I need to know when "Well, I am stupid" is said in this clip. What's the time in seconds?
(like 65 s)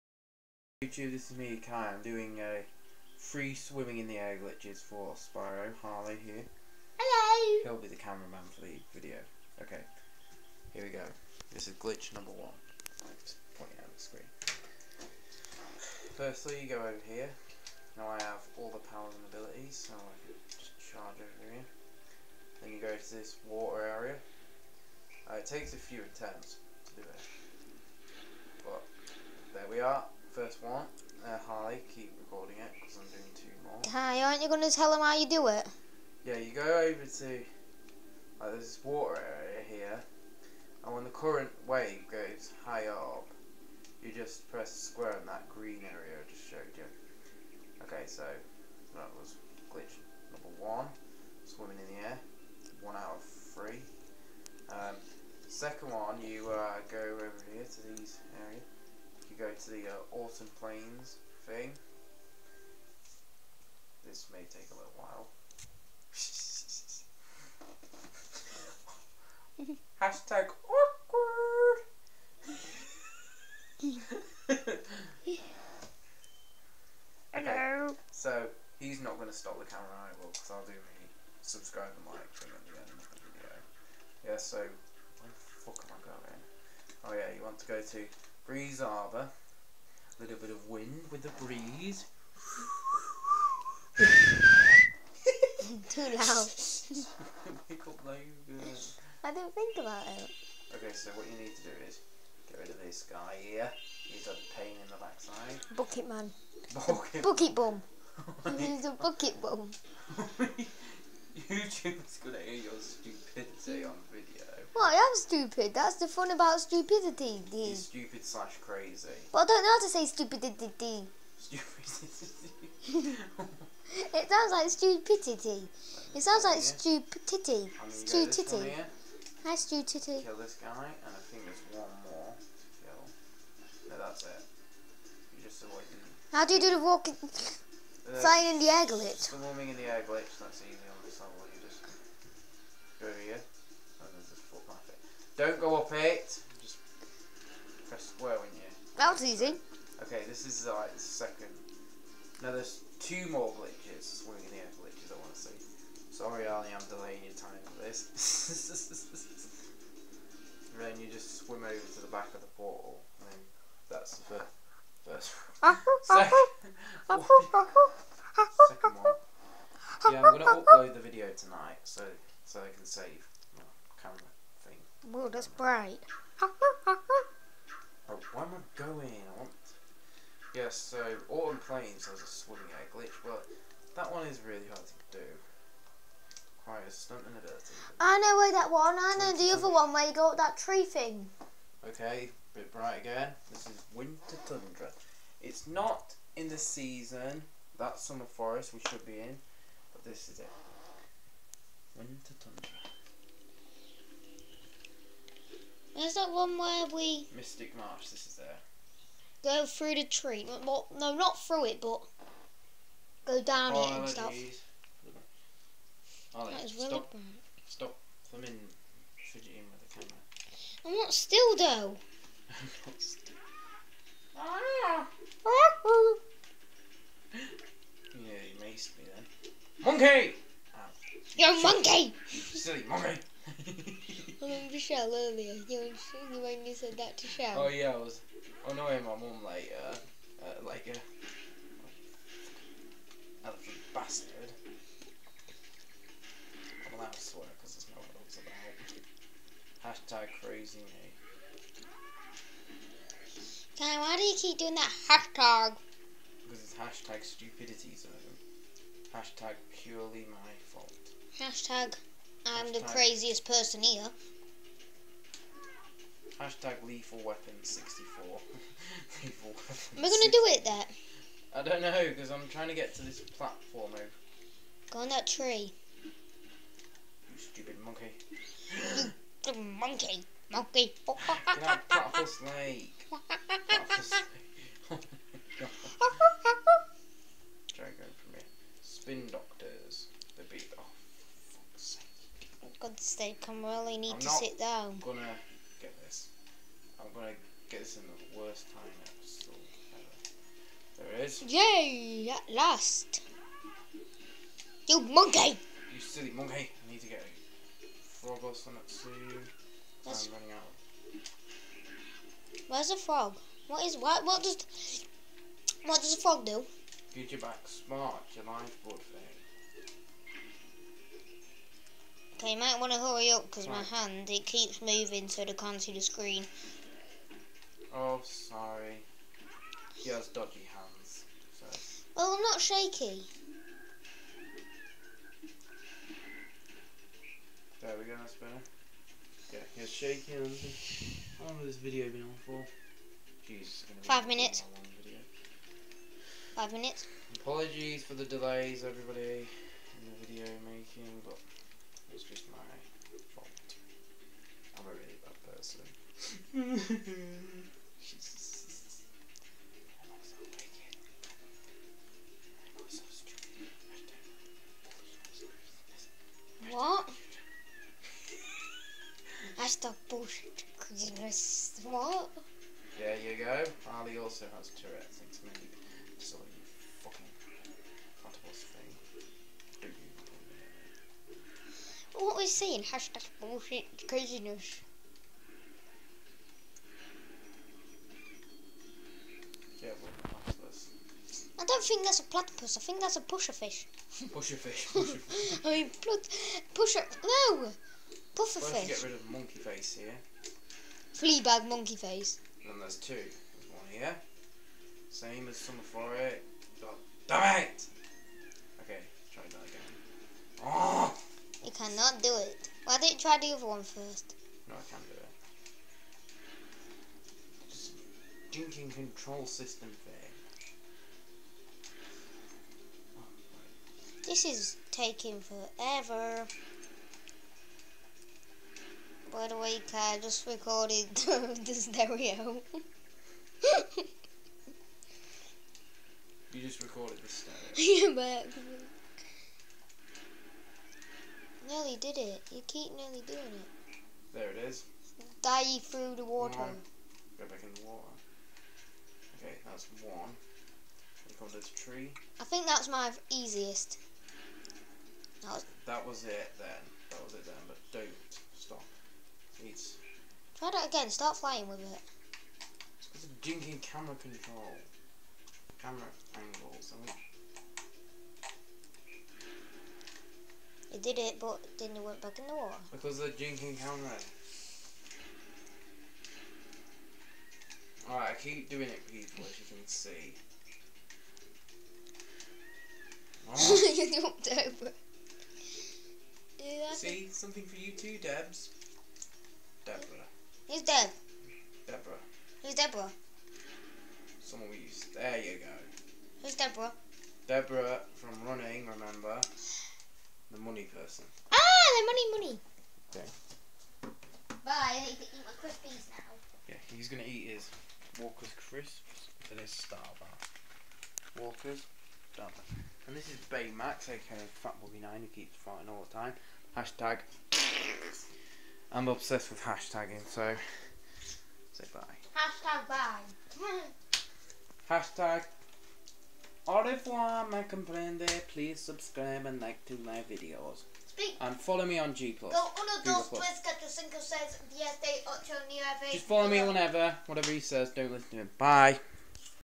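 114 s.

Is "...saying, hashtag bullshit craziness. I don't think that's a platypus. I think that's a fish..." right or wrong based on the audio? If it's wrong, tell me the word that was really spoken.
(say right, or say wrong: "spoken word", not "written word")
right.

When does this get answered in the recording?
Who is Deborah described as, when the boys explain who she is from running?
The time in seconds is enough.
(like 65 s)
500 s.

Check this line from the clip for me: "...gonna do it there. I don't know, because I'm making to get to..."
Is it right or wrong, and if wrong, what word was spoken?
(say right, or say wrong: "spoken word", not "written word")
wrong: "trying", not "making".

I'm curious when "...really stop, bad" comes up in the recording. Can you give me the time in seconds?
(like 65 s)
216 s.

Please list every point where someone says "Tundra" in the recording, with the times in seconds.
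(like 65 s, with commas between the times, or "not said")
194 s, 202 s.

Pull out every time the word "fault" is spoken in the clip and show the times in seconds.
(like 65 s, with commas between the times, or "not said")
260 s, 353 s.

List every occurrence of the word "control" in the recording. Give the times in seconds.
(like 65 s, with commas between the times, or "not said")
418 s, 464 s.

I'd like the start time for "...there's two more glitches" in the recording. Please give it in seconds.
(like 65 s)
152 s.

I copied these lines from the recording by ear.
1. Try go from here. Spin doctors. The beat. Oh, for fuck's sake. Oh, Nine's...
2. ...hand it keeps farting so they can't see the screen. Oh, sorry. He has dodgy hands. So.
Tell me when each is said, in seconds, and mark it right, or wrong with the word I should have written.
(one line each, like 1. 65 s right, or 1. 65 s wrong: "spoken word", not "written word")
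1. 287 s wrong: "God", not "Nine"
2. 323 s wrong: "moving", not "farting".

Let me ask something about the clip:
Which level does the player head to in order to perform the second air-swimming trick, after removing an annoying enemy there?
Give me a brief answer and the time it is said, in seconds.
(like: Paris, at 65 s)
Breeze Harbor, at 88 s.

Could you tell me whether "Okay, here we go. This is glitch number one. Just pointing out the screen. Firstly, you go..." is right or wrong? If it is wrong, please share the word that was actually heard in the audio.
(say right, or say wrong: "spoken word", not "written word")
right.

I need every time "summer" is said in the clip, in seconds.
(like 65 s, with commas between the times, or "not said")
197 s, 405 s.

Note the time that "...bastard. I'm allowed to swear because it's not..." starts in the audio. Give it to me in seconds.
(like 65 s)
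243 s.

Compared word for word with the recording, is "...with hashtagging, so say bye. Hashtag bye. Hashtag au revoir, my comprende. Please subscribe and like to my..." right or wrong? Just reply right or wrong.
right.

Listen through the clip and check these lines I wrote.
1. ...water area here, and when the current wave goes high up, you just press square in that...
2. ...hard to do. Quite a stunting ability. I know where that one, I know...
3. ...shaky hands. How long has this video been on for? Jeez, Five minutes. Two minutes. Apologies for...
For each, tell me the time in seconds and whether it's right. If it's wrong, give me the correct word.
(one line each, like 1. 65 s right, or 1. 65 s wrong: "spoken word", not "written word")
1. 38 s right
2. 184 s right
3. 339 s wrong: "Five", not "Two".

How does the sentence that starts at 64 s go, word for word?
This may take a little while.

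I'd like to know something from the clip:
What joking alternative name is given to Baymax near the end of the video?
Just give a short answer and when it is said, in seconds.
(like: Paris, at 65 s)
Fat Bobby Nine, at 514 s.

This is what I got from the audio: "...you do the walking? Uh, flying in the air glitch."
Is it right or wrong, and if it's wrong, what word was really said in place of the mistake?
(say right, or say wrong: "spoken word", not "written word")
right.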